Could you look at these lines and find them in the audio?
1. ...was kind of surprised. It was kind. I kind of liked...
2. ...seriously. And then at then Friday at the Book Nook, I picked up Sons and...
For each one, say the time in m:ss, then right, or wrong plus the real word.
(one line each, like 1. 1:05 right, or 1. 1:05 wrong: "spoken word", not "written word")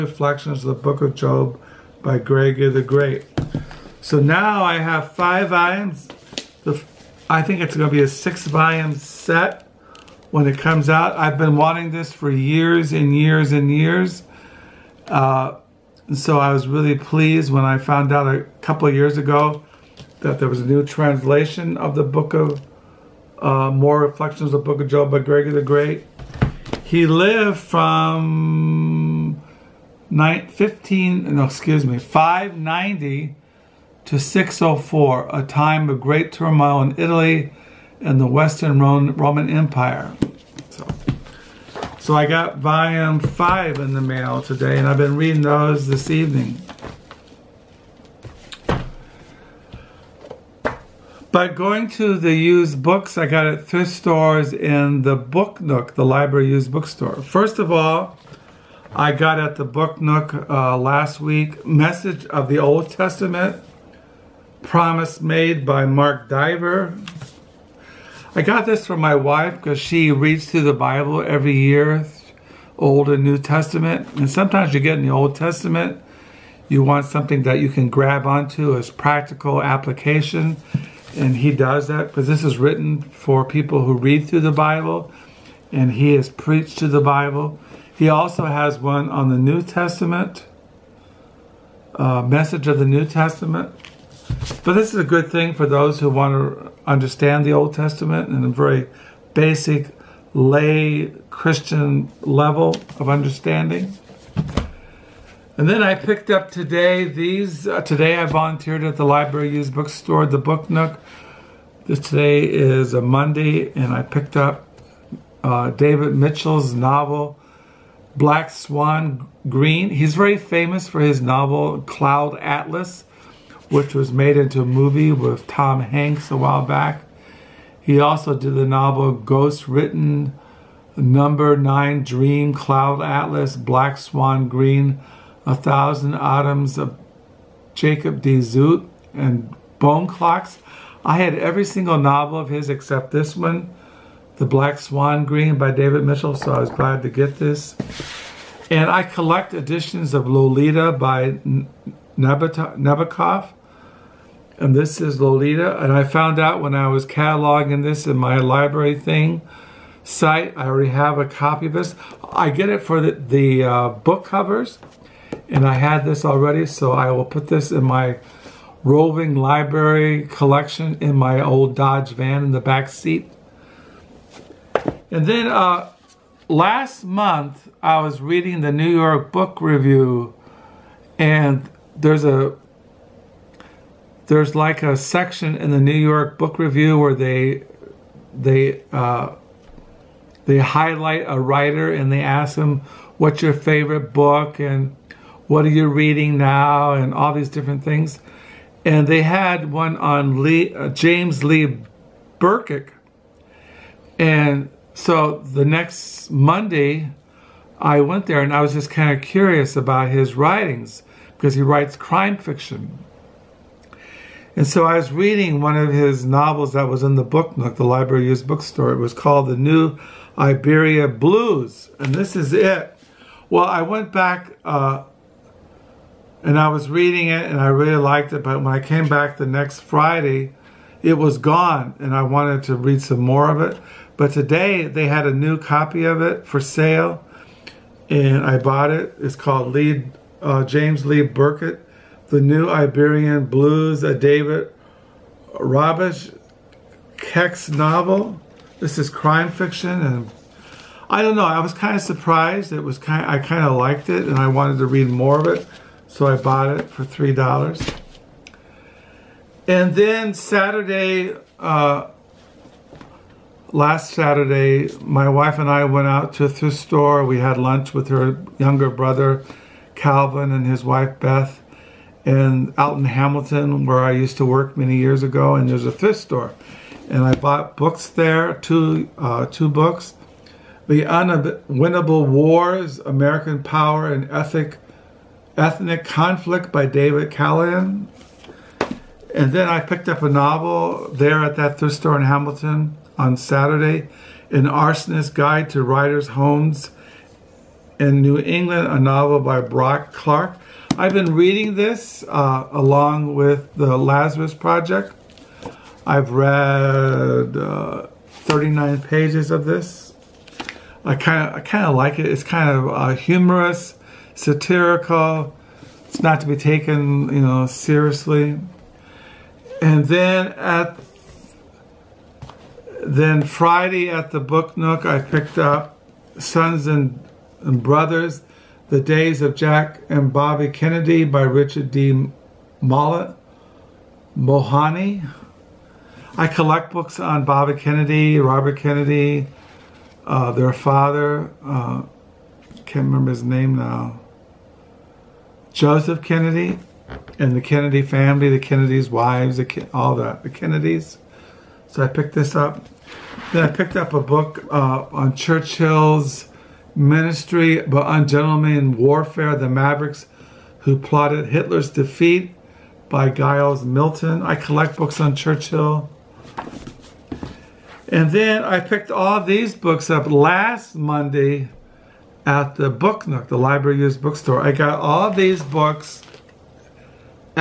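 1. 4:11 right
2. 5:17 right.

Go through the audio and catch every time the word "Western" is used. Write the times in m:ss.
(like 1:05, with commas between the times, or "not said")
0:38.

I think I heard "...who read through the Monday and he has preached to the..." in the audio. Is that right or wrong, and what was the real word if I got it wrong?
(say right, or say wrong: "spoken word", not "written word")
wrong: "Bible", not "Monday".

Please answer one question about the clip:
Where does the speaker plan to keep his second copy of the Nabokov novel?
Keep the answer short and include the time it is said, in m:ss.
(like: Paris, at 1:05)
Dodge van, at 2:51.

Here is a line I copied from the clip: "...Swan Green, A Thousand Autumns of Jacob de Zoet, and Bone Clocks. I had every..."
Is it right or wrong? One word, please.
right.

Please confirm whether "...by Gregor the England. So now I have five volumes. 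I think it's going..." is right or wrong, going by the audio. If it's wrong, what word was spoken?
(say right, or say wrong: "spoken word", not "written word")
wrong: "Great", not "England".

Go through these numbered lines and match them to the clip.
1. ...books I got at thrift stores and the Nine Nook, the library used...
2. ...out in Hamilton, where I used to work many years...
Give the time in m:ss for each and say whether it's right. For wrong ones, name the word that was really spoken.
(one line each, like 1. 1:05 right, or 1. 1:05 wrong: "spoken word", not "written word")
1. 0:52 wrong: "Book", not "Nine"
2. 4:32 right.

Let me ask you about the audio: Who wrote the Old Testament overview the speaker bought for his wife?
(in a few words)
Mark Dever.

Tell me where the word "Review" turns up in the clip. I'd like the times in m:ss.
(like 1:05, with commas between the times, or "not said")
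2:59, 3:06.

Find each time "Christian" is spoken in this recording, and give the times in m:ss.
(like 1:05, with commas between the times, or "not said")
1:41.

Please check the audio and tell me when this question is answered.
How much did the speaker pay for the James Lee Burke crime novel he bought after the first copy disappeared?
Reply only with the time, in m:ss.
4:17.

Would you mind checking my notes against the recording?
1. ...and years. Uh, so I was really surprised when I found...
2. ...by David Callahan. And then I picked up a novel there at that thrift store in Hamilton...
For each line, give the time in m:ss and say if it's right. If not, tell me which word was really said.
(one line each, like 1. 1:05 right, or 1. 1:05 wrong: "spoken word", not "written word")
1. 0:13 wrong: "pleased", not "surprised"
2. 4:46 right.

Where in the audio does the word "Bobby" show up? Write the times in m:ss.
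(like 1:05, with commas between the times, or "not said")
5:30, 5:37.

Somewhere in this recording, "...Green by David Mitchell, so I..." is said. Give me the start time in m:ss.
2:25.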